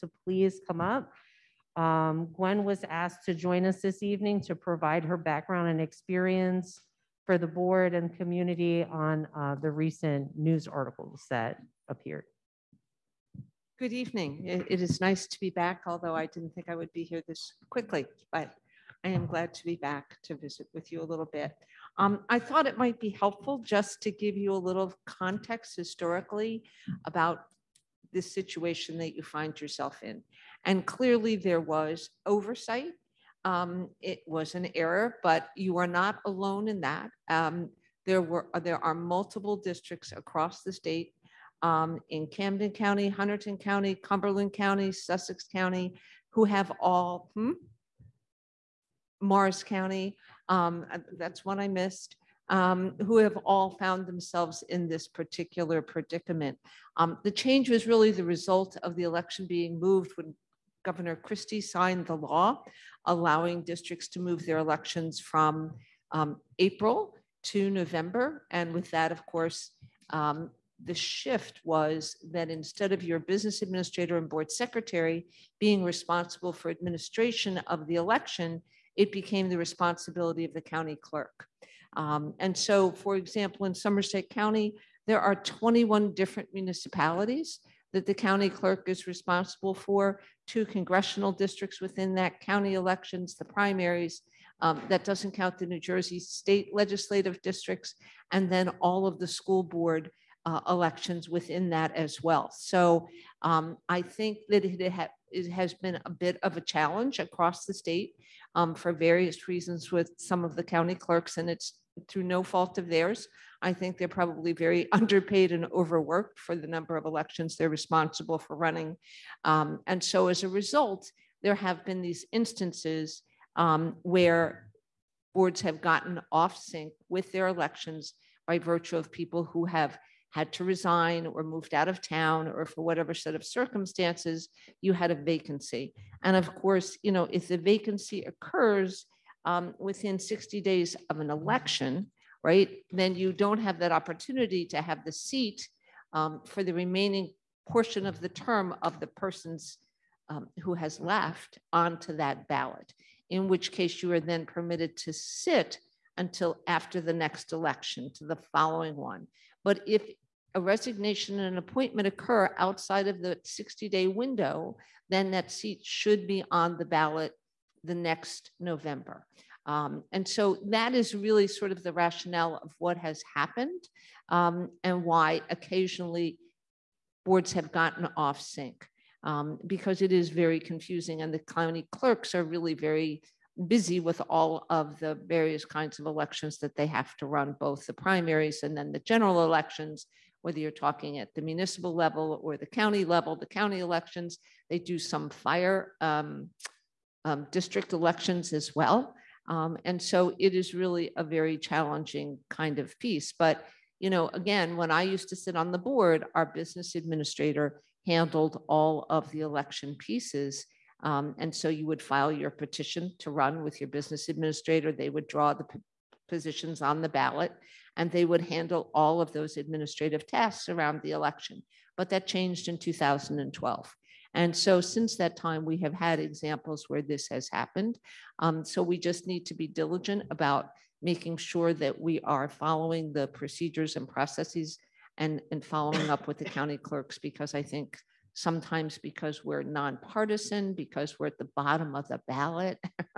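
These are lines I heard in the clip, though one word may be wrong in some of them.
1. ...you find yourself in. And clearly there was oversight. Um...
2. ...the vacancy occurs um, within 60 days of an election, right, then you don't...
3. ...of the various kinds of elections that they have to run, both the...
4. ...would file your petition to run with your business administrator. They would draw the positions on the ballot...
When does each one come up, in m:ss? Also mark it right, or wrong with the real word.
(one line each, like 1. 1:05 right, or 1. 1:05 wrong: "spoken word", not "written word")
1. 0:29 right
2. 2:17 right
3. 3:04 right
4. 3:31 right.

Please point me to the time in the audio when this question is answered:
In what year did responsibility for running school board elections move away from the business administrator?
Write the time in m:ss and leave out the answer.
3:42.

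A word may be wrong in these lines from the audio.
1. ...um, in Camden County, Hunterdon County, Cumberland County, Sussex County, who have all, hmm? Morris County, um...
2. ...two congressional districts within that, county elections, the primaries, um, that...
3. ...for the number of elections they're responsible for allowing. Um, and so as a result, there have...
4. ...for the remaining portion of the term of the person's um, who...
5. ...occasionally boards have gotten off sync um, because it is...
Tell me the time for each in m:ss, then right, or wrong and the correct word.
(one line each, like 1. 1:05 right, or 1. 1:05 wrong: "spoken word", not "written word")
1. 0:41 right
2. 1:30 right
3. 1:56 wrong: "running", not "allowing"
4. 2:26 right
5. 2:55 right.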